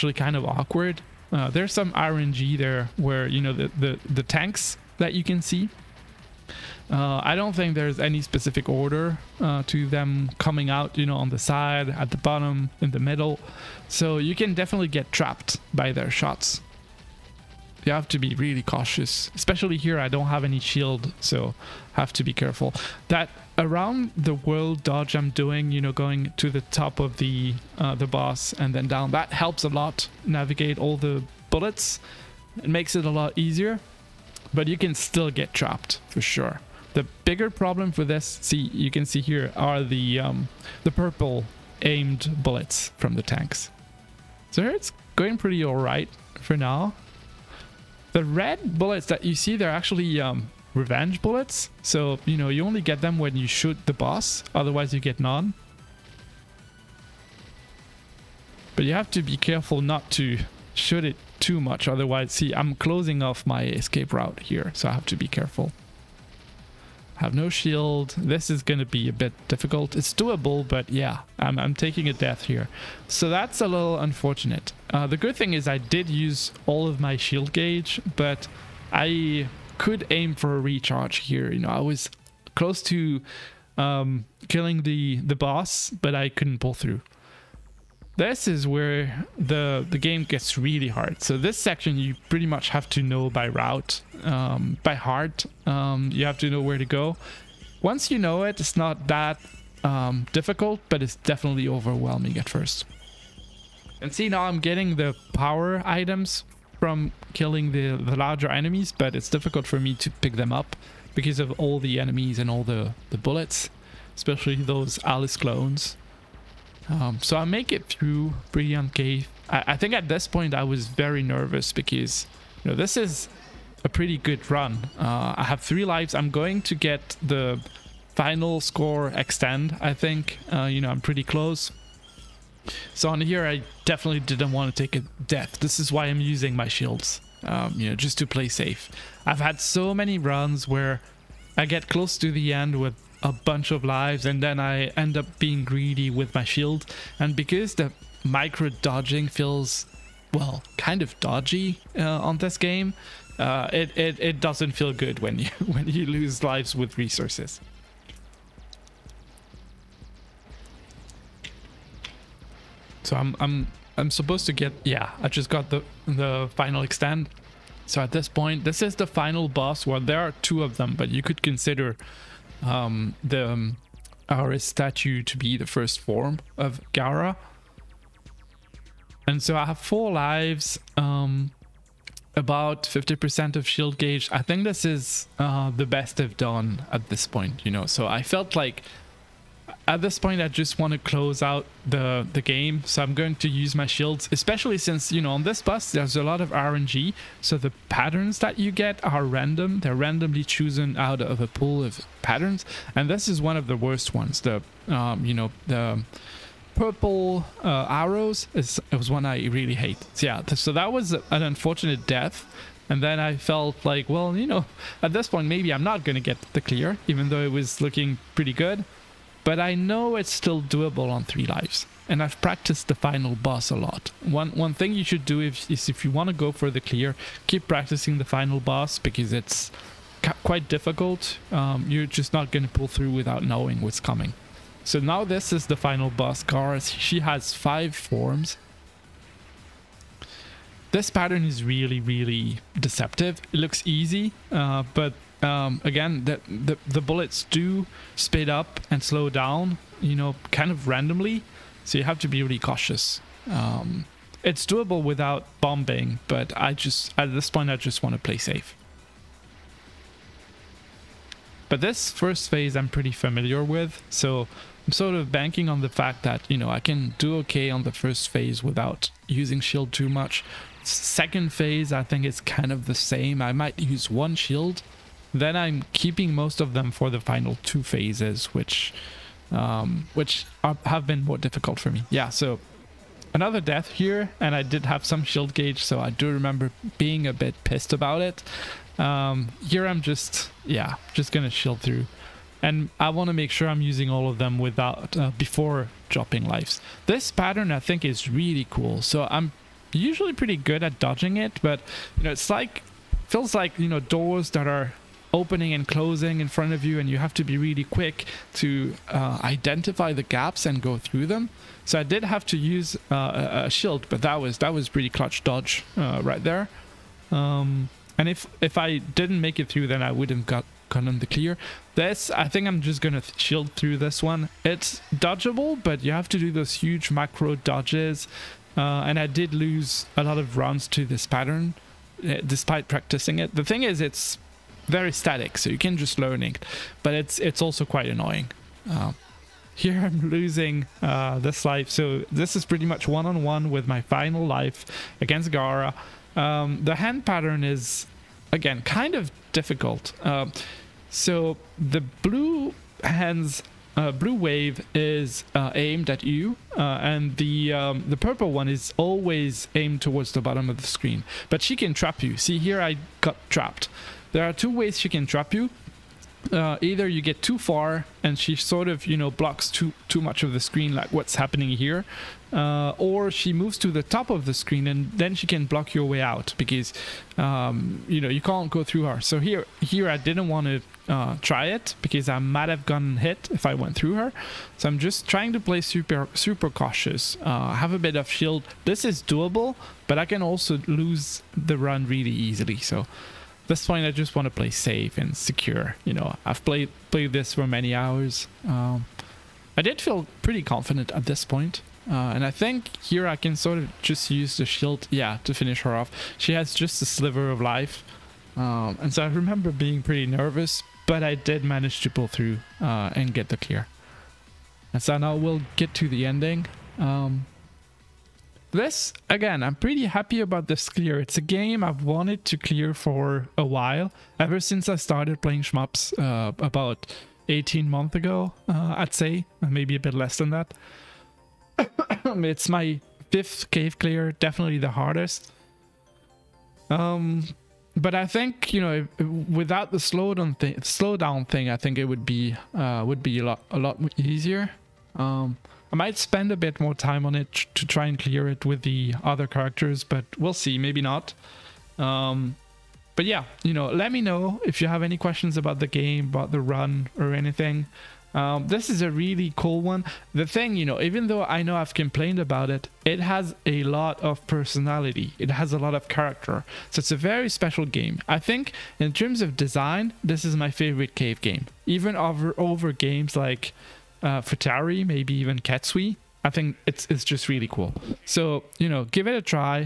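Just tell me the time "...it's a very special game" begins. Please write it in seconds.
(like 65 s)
466 s.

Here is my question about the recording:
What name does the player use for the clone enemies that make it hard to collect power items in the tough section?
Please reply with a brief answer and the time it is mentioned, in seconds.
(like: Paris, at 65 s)
Alice, at 115 s.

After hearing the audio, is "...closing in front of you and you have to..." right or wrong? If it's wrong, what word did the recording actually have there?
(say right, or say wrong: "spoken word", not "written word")
right.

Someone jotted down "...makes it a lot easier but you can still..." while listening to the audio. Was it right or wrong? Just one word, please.
right.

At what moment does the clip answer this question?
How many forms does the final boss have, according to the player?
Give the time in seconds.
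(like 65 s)
237 s.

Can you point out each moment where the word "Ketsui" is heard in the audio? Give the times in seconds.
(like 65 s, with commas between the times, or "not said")
475 s.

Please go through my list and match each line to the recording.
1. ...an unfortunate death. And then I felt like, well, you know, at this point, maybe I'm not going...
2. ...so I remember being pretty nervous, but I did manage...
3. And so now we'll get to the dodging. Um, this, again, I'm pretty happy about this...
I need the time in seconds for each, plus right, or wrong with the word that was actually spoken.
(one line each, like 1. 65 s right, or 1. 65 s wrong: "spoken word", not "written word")
1. 211 s right
2. 409 s right
3. 414 s wrong: "ending", not "dodging".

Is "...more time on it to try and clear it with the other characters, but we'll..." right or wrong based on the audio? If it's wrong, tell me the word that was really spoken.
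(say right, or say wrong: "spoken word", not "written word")
right.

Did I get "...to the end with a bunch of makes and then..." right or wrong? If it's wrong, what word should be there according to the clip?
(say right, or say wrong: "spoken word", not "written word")
wrong: "lives", not "makes".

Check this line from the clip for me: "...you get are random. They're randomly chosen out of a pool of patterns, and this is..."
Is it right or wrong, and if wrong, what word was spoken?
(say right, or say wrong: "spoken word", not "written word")
right.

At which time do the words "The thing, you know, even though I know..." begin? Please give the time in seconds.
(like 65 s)
460 s.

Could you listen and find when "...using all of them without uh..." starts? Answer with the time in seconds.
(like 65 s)
293 s.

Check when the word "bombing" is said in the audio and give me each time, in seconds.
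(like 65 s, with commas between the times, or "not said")
255 s.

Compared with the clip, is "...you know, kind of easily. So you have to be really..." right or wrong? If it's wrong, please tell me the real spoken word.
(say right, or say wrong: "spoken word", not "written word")
wrong: "randomly", not "easily".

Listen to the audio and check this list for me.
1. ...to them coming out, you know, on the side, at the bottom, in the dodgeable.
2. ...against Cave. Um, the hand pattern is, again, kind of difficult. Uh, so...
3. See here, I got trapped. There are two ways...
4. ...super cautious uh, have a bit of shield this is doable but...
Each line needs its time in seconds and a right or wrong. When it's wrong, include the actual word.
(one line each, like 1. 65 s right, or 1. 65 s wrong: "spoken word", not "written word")
1. 9 s wrong: "middle", not "dodgeable"
2. 345 s wrong: "Gara", not "Cave"
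3. 362 s right
4. 386 s right.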